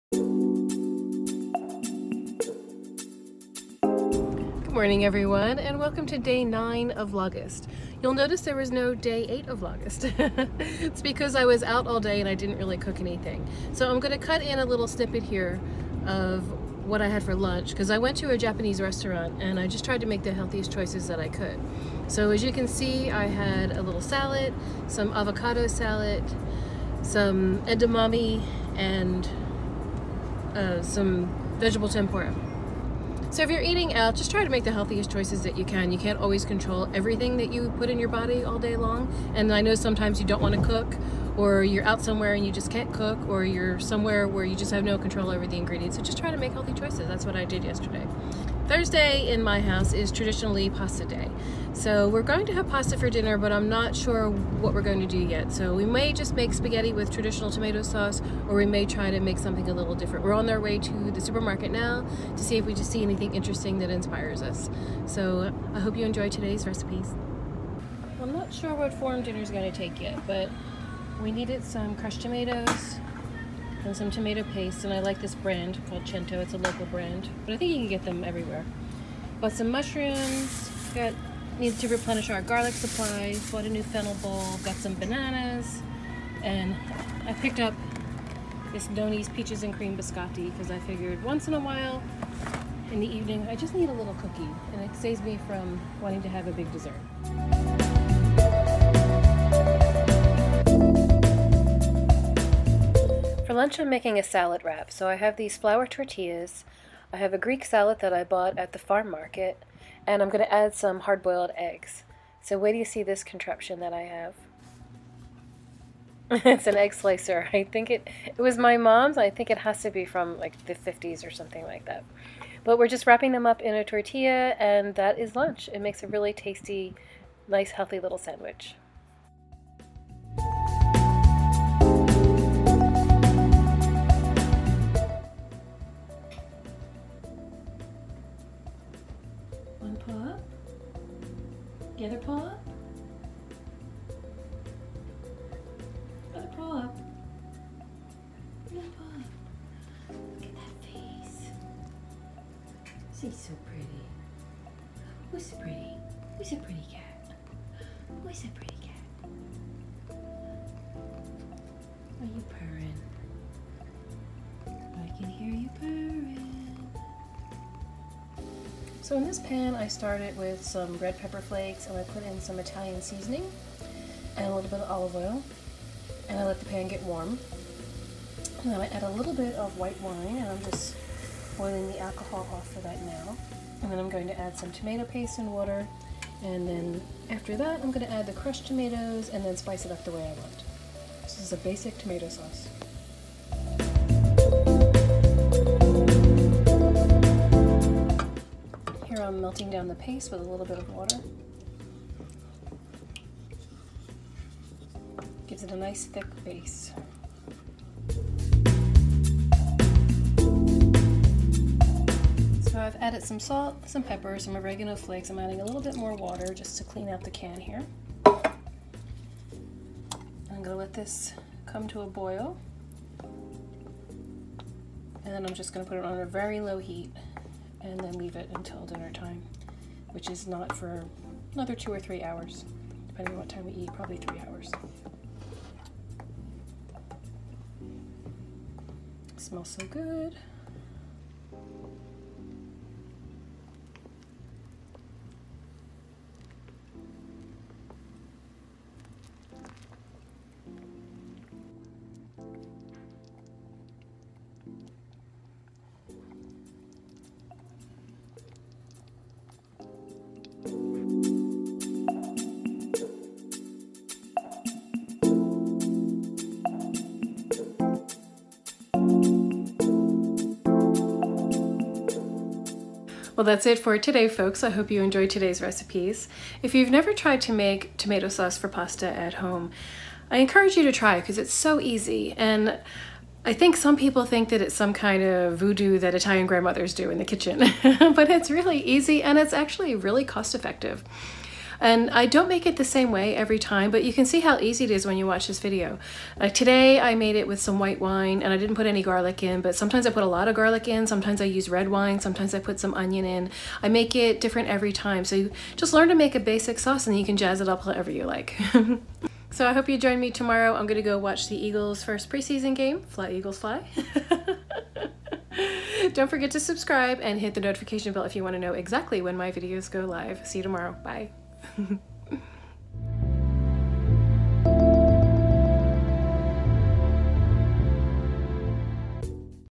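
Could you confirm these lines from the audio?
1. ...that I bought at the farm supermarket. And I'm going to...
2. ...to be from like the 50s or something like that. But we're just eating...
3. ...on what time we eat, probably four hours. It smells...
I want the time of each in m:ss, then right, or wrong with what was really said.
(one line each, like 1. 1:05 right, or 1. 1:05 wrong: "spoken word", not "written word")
1. 1:47 wrong: "market", not "supermarket"
2. 1:59 wrong: "wrapping", not "eating"
3. 3:53 wrong: "three", not "four".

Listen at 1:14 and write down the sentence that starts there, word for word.
And I like this brand called Cento.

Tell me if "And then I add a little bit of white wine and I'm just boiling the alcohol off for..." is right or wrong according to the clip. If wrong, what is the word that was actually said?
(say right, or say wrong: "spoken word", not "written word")
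right.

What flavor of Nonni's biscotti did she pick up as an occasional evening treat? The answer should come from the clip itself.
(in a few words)
Peaches and cream.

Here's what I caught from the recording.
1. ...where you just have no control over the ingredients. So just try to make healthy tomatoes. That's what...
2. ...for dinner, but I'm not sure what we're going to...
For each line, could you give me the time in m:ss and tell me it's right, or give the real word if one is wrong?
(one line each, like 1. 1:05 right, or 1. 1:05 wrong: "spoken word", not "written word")
1. 0:44 wrong: "choices", not "tomatoes"
2. 0:52 right.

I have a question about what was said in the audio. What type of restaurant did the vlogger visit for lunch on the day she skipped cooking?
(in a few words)
Japanese.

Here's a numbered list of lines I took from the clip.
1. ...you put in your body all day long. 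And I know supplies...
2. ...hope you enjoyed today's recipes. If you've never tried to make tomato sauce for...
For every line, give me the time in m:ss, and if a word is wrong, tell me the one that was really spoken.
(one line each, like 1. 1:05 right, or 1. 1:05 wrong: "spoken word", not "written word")
1. 0:37 wrong: "sometimes", not "supplies"
2. 4:34 right.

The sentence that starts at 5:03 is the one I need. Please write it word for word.
I make it different every time.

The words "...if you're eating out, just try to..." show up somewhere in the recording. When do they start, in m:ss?
0:33.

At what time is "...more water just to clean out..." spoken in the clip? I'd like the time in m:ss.
3:35.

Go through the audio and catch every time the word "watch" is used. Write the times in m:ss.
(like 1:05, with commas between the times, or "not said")
4:55, 5:11.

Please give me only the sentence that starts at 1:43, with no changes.
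For lunch, I'm making a salad wrap.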